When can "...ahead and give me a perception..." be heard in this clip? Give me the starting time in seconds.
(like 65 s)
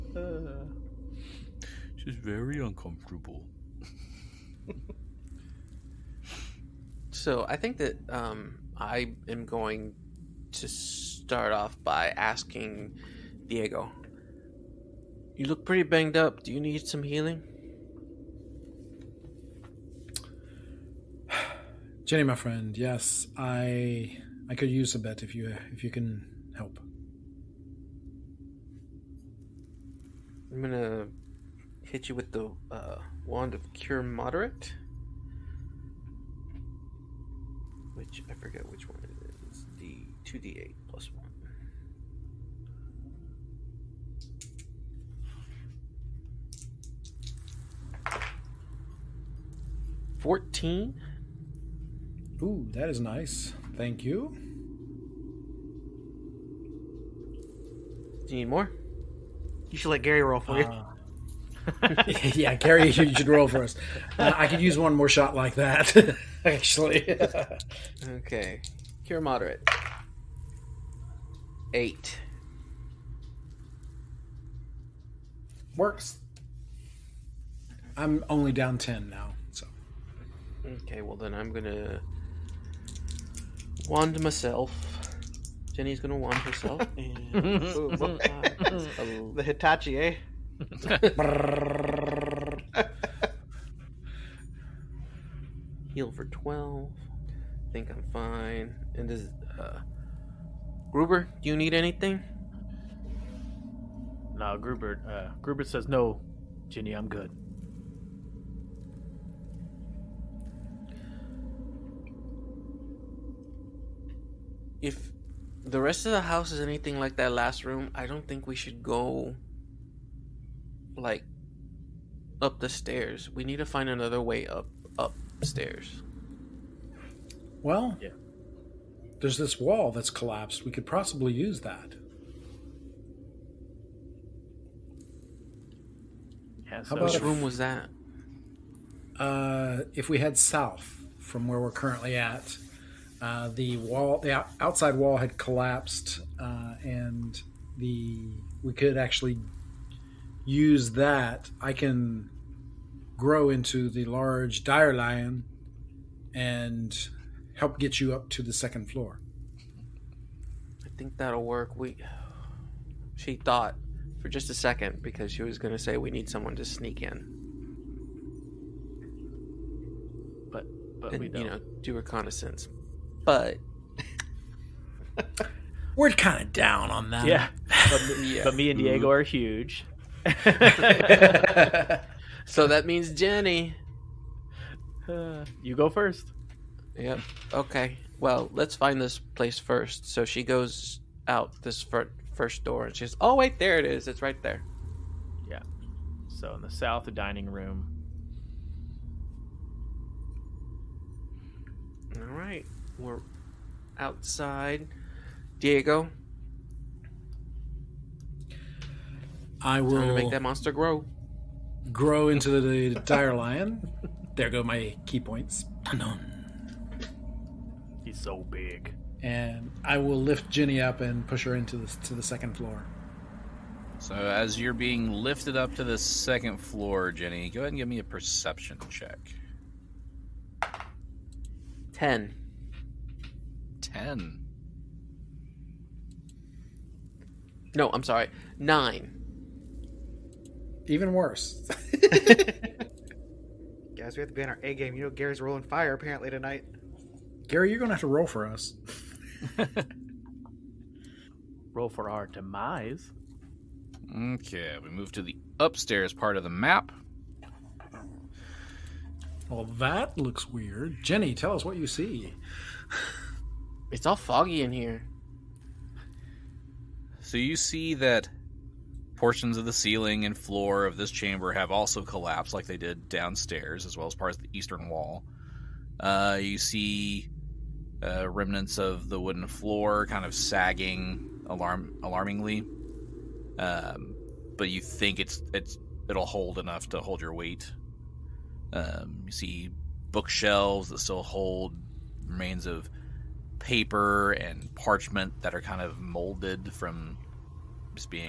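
227 s.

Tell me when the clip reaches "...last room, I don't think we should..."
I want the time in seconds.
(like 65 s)
117 s.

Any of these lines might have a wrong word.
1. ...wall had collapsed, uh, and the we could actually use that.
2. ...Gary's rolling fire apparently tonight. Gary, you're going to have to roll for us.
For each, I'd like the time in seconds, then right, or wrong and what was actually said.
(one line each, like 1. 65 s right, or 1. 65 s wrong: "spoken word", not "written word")
1. 144 s right
2. 245 s right.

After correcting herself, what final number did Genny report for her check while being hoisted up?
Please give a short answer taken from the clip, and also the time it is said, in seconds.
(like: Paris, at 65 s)
9, at 238 s.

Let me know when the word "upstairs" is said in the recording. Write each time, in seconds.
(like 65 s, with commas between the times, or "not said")
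124 s, 255 s.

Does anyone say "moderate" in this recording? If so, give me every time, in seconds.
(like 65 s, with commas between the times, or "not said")
34 s, 69 s.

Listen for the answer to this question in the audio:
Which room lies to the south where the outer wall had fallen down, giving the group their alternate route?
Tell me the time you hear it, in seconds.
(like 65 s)
197 s.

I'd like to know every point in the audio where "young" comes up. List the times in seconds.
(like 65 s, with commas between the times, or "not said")
not said.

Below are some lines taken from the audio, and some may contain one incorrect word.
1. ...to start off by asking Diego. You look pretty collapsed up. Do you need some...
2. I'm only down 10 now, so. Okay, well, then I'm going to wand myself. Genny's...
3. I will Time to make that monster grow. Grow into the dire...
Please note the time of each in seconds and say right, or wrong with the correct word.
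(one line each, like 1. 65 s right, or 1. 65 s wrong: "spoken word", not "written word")
1. 10 s wrong: "banged", not "collapsed"
2. 77 s right
3. 209 s right.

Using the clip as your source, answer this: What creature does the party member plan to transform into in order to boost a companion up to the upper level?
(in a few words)
large dire lion.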